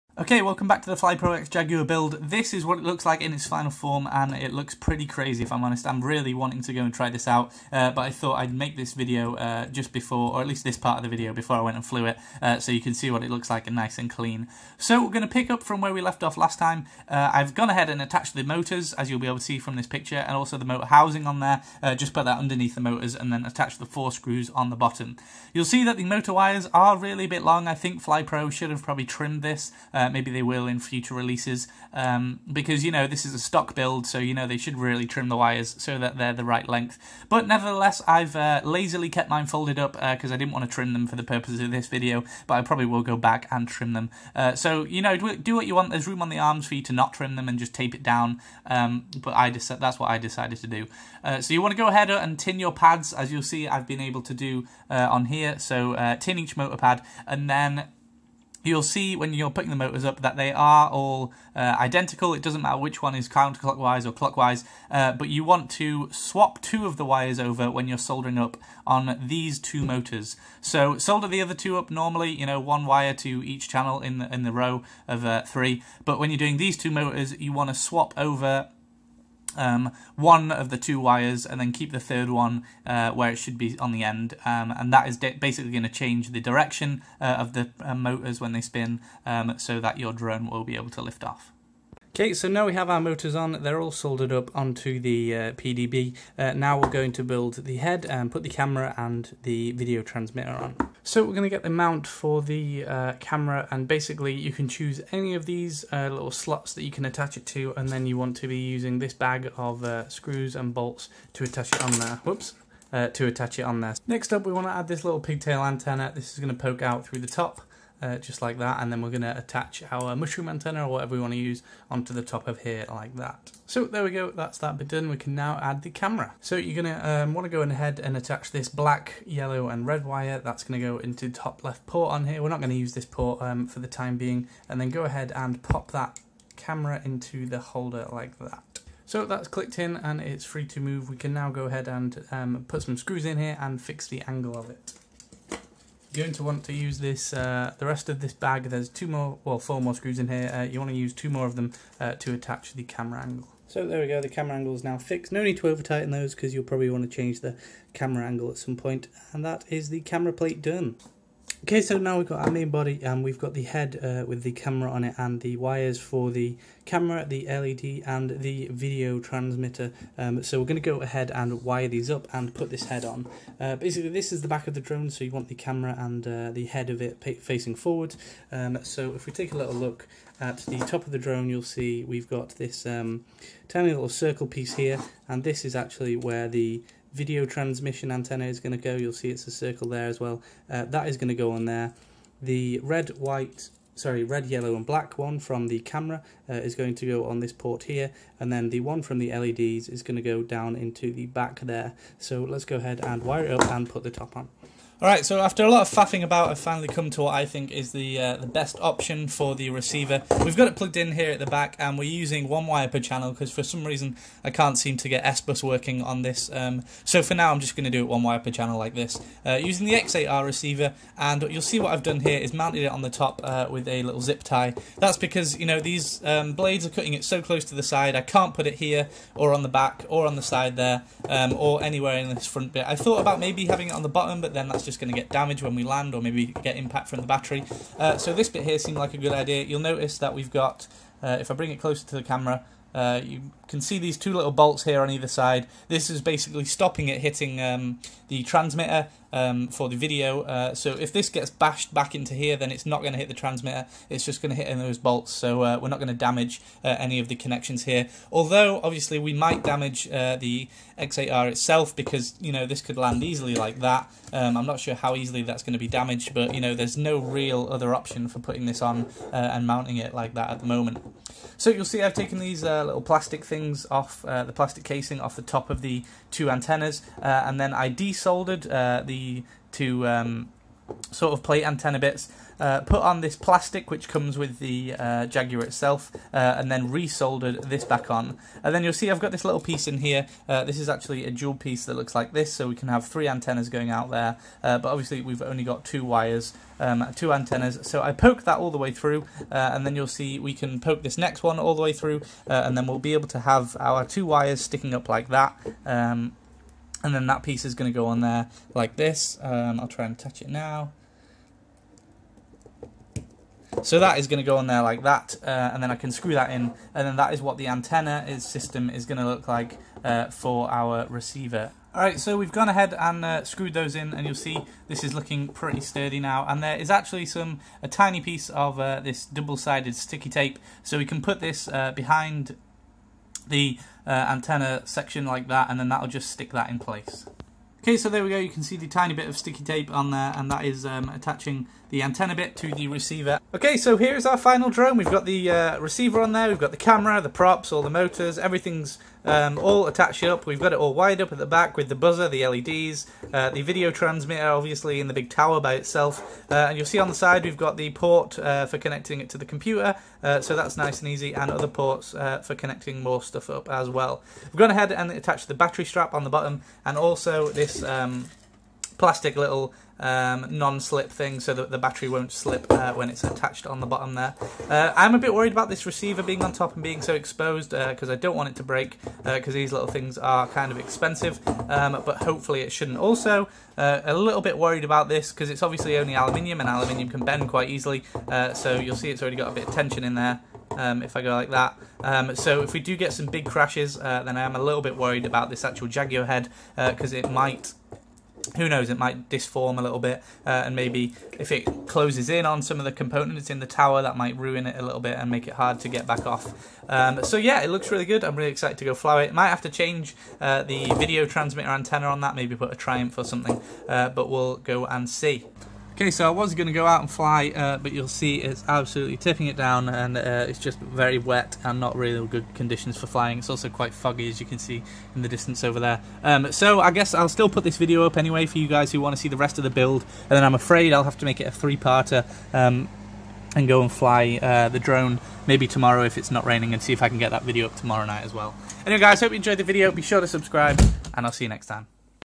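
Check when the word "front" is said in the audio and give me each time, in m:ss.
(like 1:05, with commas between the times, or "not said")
3:52.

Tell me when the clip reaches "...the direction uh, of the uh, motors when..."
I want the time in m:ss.
1:26.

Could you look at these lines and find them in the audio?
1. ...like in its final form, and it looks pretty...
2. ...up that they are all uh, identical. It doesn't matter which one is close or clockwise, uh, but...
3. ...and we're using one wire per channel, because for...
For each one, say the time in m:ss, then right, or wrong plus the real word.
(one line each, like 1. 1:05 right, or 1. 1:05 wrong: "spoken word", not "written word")
1. 0:03 right
2. 1:00 wrong: "counterclockwise", not "close"
3. 3:31 right.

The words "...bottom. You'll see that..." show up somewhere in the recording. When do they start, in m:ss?
0:24.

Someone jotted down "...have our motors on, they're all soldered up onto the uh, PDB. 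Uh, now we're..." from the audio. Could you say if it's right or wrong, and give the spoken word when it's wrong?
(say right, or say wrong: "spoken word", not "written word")
right.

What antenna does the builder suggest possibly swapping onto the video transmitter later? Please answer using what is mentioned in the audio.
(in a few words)
Triumph.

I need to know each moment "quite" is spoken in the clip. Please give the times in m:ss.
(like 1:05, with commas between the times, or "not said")
6:27, 7:03.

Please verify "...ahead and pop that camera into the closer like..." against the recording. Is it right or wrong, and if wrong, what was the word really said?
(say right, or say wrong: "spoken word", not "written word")
wrong: "holder", not "closer".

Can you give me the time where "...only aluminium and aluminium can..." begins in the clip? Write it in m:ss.
6:25.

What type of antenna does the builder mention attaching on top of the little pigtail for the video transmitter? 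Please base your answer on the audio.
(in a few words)
Mushroom antenna.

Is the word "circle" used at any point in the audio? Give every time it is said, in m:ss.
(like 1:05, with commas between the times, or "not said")
3:04, 3:09.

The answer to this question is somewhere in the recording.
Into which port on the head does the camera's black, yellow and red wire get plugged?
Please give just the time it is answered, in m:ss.
2:11.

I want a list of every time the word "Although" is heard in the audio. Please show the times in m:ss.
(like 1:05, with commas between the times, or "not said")
4:18.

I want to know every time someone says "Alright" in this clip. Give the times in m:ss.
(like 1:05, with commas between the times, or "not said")
3:25, 5:21.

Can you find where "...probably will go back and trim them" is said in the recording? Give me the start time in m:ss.
0:42.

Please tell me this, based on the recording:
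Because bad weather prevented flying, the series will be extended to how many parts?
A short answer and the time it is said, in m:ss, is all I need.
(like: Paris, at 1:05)
3, at 7:11.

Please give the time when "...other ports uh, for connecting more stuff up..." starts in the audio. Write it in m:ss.
6:01.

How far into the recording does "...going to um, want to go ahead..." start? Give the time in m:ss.
2:06.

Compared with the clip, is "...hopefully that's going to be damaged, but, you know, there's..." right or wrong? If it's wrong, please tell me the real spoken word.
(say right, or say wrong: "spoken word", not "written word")
wrong: "easily", not "hopefully".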